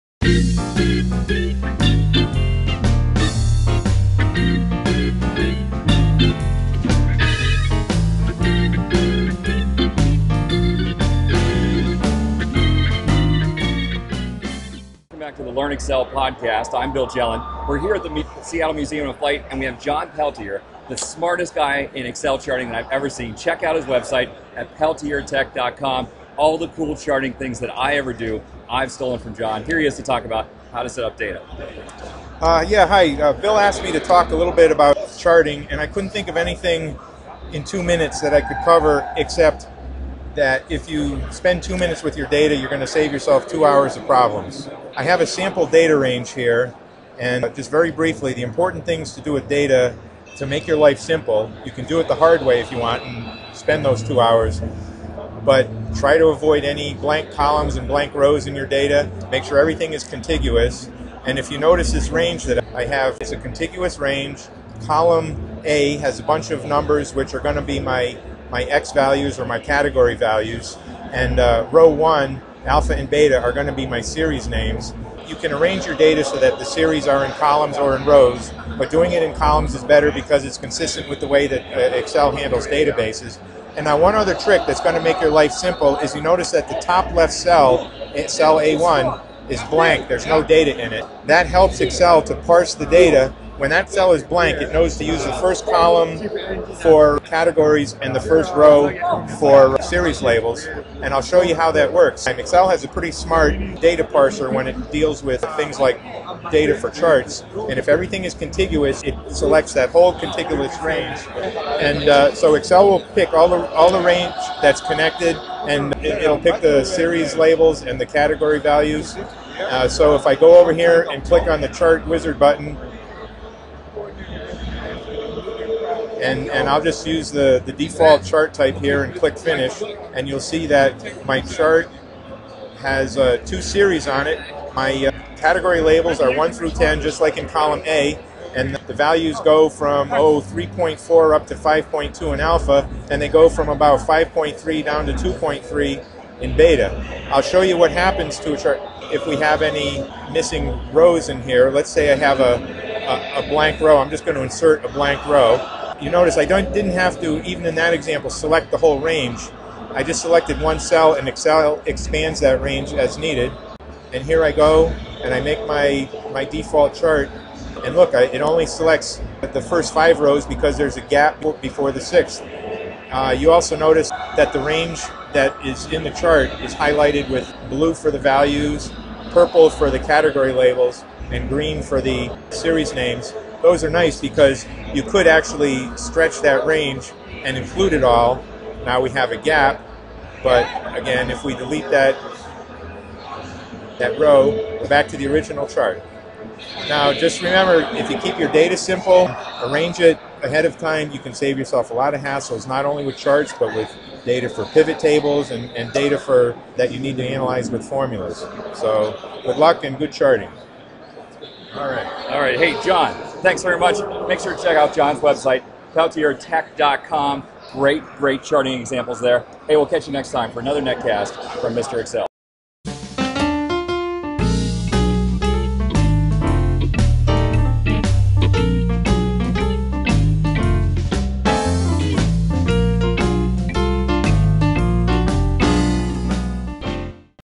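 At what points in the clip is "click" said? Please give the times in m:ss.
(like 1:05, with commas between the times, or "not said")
2:01, 2:09.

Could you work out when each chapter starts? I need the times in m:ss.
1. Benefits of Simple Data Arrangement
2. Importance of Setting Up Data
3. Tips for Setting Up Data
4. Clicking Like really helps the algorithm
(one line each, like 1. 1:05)
1. 0:39
2. 0:19
3. 0:29
4. 3:16.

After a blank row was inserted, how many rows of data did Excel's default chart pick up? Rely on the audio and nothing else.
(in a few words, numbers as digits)
5.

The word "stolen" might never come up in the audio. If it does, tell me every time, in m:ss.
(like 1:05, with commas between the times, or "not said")
0:28.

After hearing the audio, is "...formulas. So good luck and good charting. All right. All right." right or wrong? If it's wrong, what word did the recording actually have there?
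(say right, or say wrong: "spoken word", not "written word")
right.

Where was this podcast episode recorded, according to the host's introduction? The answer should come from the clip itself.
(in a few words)
Seattle Museum of Flight.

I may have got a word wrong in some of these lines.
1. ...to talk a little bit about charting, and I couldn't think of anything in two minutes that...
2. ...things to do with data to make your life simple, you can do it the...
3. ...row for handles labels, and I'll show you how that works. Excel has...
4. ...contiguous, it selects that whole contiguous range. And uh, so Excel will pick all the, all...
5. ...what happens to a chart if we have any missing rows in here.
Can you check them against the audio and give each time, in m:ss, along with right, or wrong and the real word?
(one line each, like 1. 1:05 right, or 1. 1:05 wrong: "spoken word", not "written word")
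1. 0:33 right
2. 0:48 right
3. 1:38 wrong: "series", not "handles"
4. 1:48 right
5. 2:27 right.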